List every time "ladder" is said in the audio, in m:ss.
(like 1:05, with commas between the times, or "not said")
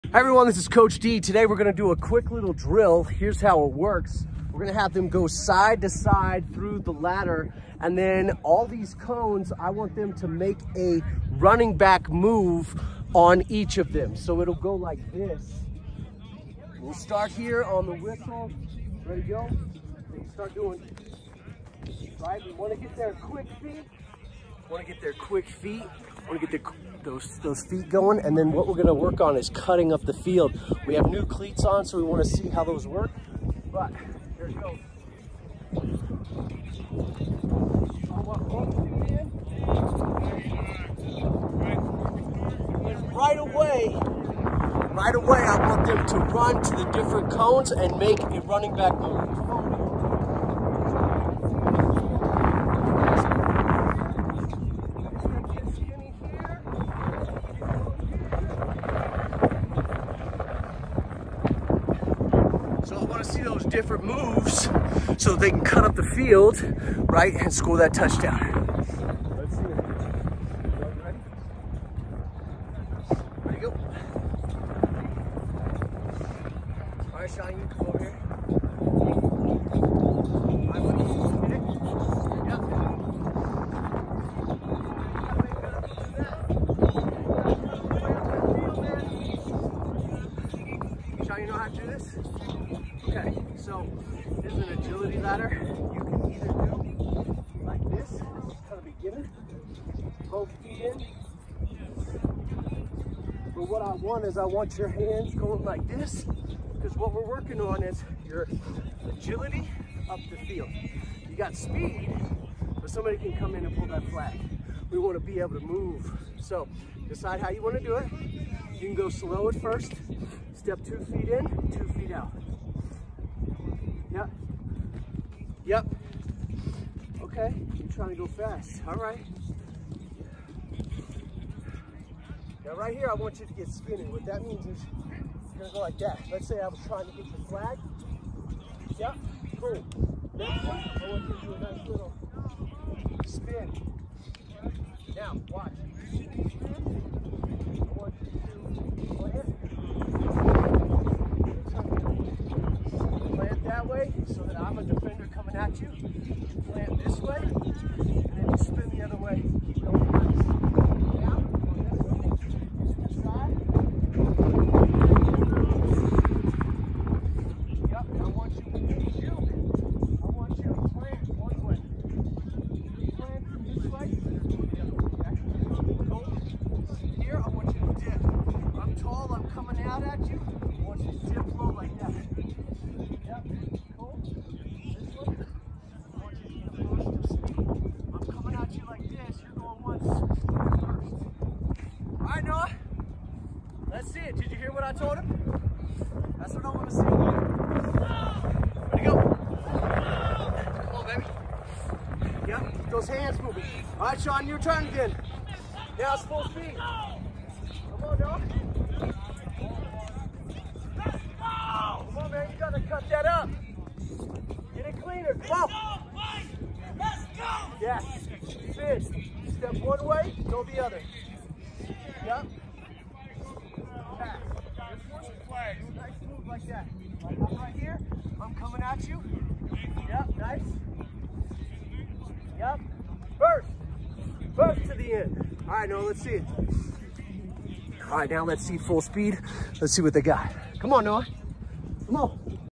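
0:06, 1:35.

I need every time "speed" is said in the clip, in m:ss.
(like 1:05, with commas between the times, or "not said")
1:51, 3:26, 3:58.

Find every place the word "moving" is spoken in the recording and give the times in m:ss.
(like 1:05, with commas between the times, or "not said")
3:23.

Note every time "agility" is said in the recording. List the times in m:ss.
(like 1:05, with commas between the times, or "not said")
1:34, 1:49.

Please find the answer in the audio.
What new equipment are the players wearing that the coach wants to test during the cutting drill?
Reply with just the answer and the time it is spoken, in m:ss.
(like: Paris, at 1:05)
new cleats, at 0:31.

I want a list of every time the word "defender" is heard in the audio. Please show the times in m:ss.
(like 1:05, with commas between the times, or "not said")
2:34.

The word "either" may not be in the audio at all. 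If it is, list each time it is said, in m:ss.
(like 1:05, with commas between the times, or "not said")
1:36.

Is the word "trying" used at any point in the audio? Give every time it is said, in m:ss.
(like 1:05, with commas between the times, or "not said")
2:07, 2:16.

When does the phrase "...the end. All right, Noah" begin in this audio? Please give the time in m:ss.
3:54.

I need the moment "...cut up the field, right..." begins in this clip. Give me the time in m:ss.
1:05.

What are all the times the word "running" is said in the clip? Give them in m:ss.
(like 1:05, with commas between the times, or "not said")
0:11, 0:48.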